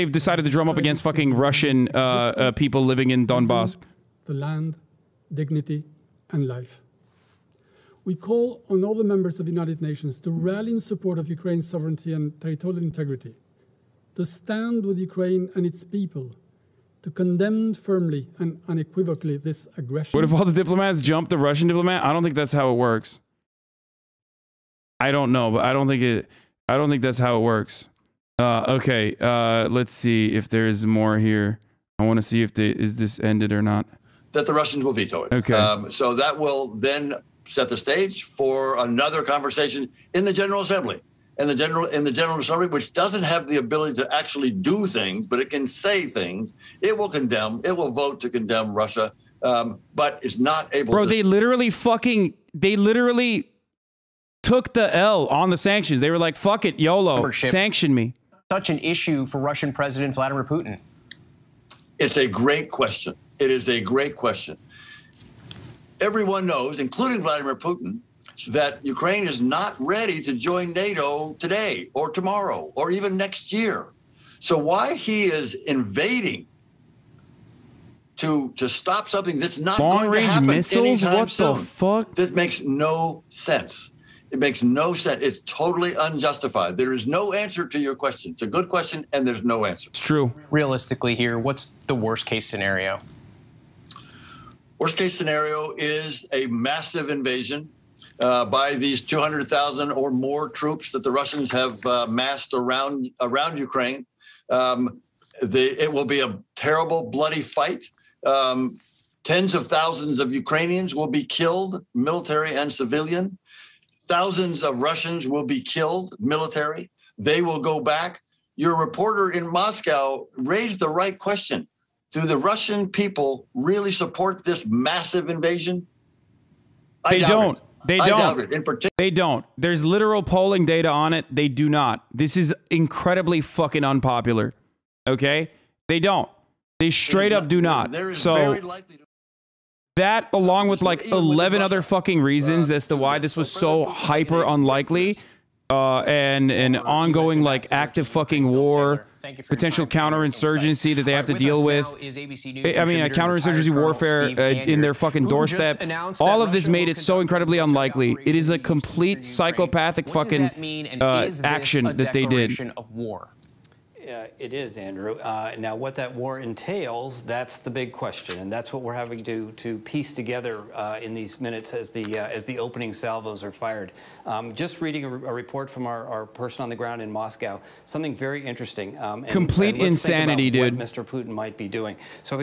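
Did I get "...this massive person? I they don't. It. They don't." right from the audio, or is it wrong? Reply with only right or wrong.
wrong.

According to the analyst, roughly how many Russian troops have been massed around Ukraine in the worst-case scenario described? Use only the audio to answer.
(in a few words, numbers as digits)
200,000.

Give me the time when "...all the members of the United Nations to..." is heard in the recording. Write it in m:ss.
0:08.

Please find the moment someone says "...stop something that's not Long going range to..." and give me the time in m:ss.
1:18.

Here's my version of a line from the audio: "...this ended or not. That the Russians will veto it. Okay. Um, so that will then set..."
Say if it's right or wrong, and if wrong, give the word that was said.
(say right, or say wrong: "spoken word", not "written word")
right.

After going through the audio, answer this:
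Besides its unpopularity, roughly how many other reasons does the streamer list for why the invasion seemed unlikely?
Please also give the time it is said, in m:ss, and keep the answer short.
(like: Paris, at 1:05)
11, at 2:21.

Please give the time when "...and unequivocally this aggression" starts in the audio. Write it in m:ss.
0:18.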